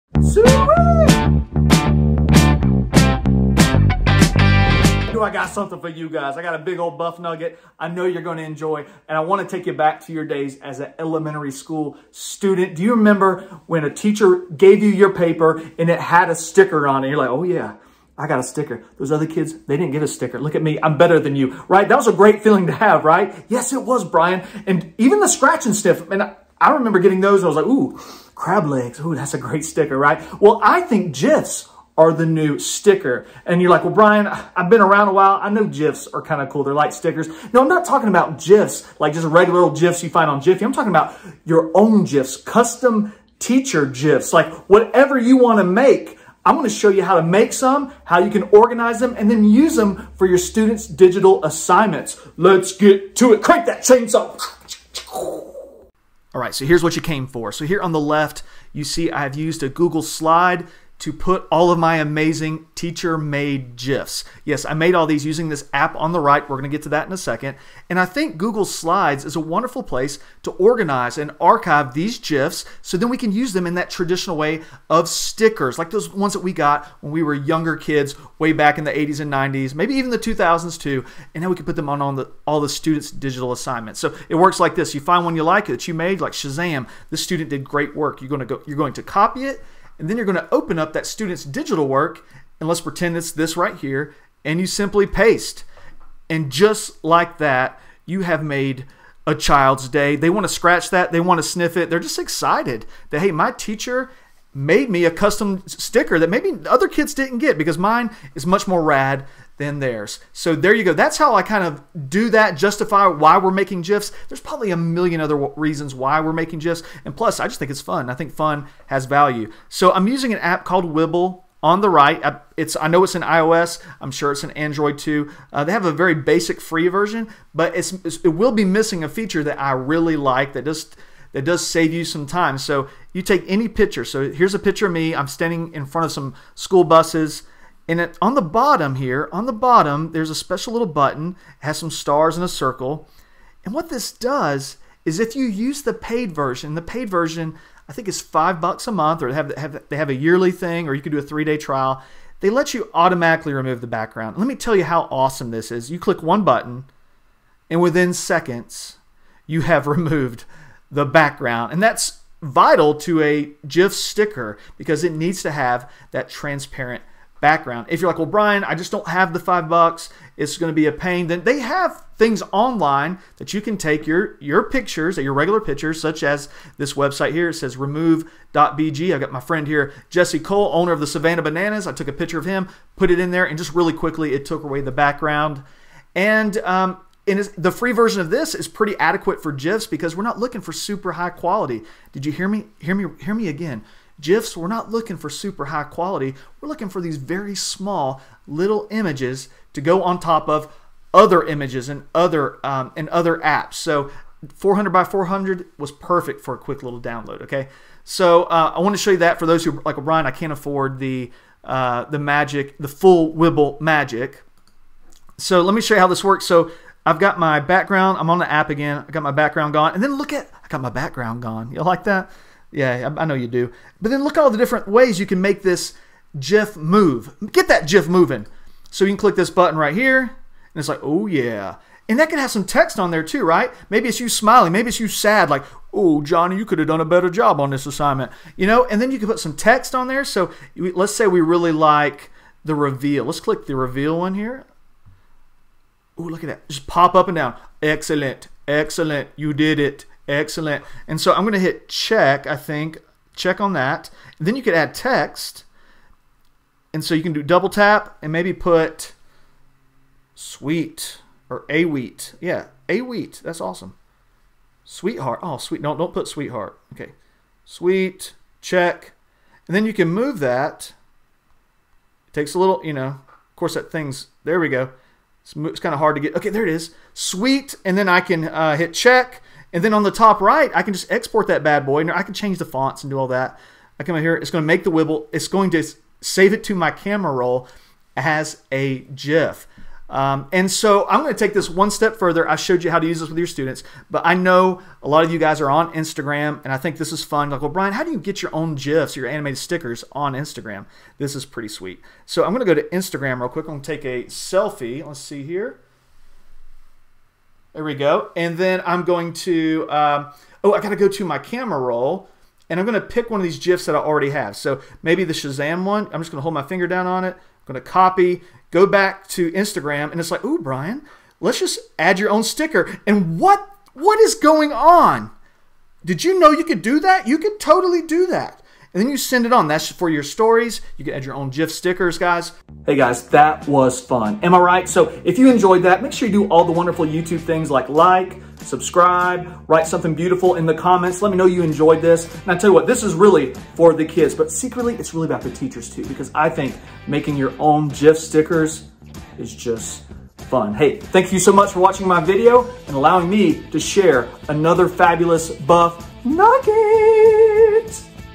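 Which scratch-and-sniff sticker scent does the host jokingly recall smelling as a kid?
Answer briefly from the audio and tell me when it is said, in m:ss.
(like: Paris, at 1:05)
Crab legs, at 0:28.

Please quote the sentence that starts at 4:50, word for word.
Um, and so I'm going to take this one step further.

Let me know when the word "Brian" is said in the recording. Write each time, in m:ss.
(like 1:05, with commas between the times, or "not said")
0:24, 0:33, 2:48, 4:57, 5:20.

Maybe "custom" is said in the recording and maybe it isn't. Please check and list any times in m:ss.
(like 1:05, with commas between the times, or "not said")
0:42, 1:45.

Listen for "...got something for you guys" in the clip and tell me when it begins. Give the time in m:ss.
0:05.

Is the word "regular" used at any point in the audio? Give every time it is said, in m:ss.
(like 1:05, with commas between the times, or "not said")
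0:39, 2:55.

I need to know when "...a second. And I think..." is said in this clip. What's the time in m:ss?
1:07.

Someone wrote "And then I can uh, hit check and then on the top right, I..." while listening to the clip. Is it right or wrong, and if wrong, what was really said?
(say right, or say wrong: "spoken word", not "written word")
right.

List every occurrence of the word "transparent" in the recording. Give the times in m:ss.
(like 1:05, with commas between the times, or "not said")
2:46.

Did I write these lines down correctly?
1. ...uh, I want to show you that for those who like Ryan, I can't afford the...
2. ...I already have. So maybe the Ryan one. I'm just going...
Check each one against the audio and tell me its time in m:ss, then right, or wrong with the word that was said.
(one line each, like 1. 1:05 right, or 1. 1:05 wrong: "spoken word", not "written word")
1. 3:28 right
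2. 5:13 wrong: "Shazam", not "Ryan".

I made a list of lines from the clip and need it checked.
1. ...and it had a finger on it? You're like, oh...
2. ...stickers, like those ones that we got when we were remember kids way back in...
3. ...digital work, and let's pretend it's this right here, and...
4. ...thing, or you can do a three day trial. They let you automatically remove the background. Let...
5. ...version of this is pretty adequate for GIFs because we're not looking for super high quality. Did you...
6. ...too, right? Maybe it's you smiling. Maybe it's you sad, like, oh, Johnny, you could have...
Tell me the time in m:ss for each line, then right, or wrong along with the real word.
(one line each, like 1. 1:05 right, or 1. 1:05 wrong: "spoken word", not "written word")
1. 0:15 wrong: "sticker", not "finger"
2. 1:15 wrong: "younger", not "remember"
3. 1:31 right
4. 2:30 right
5. 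3:07 right
6. 3:53 right.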